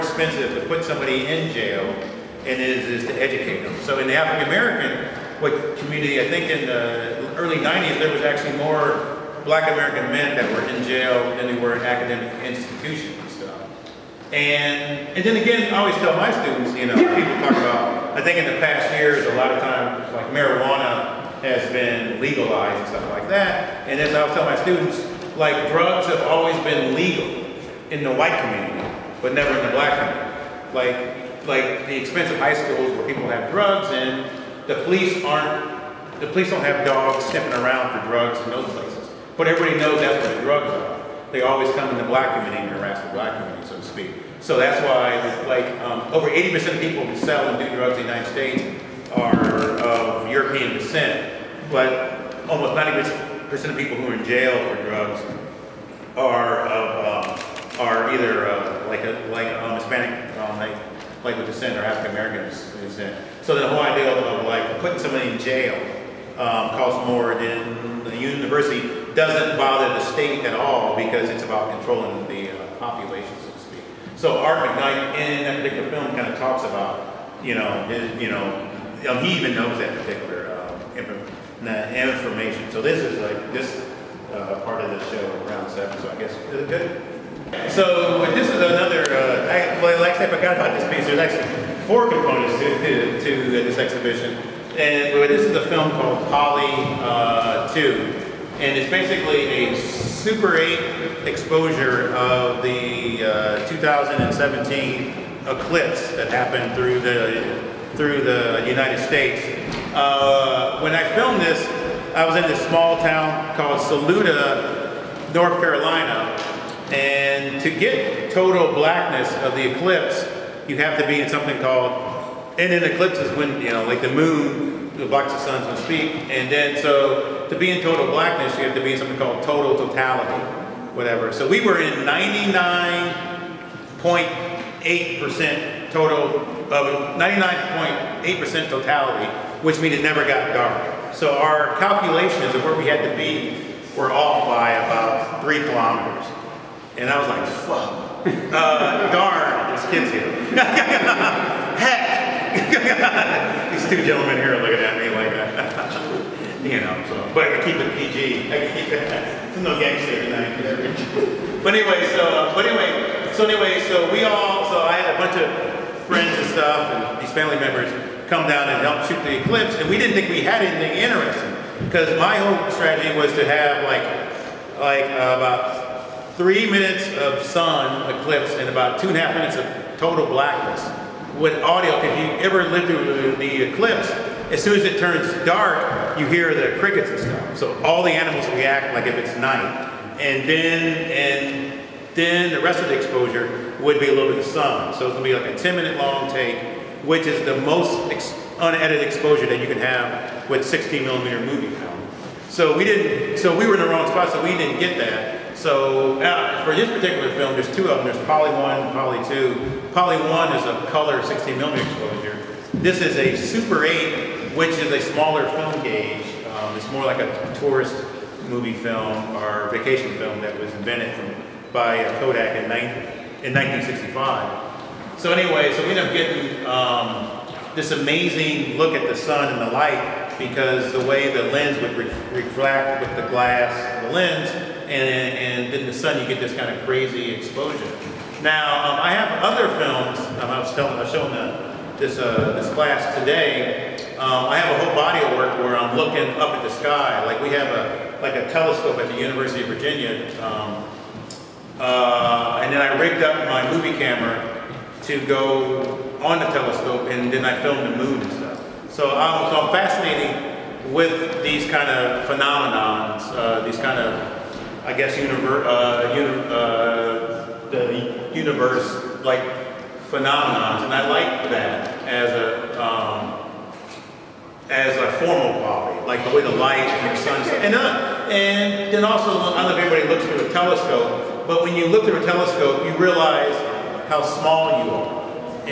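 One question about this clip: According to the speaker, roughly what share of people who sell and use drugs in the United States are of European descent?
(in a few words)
over 80%.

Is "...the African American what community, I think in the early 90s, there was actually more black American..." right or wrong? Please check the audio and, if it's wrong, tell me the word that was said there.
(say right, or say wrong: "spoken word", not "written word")
right.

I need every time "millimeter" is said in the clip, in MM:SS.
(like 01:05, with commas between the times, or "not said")
03:21, 03:31.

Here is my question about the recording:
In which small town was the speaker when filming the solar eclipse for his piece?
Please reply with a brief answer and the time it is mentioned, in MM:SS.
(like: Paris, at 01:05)
Saluda, North Carolina, at 01:53.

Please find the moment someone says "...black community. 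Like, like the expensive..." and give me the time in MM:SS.
00:29.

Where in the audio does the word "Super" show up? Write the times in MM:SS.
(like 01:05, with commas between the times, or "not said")
01:39, 03:33.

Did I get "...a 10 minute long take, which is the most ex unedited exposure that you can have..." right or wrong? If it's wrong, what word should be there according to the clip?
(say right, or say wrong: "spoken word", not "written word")
right.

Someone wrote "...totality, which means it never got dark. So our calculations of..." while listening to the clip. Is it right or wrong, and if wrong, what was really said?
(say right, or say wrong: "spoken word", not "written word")
right.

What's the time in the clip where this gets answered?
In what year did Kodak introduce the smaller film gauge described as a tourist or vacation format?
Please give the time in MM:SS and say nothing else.
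03:43.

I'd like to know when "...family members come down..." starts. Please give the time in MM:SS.
02:47.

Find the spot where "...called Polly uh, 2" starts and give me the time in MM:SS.
01:35.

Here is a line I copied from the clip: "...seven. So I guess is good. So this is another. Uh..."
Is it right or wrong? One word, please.
right.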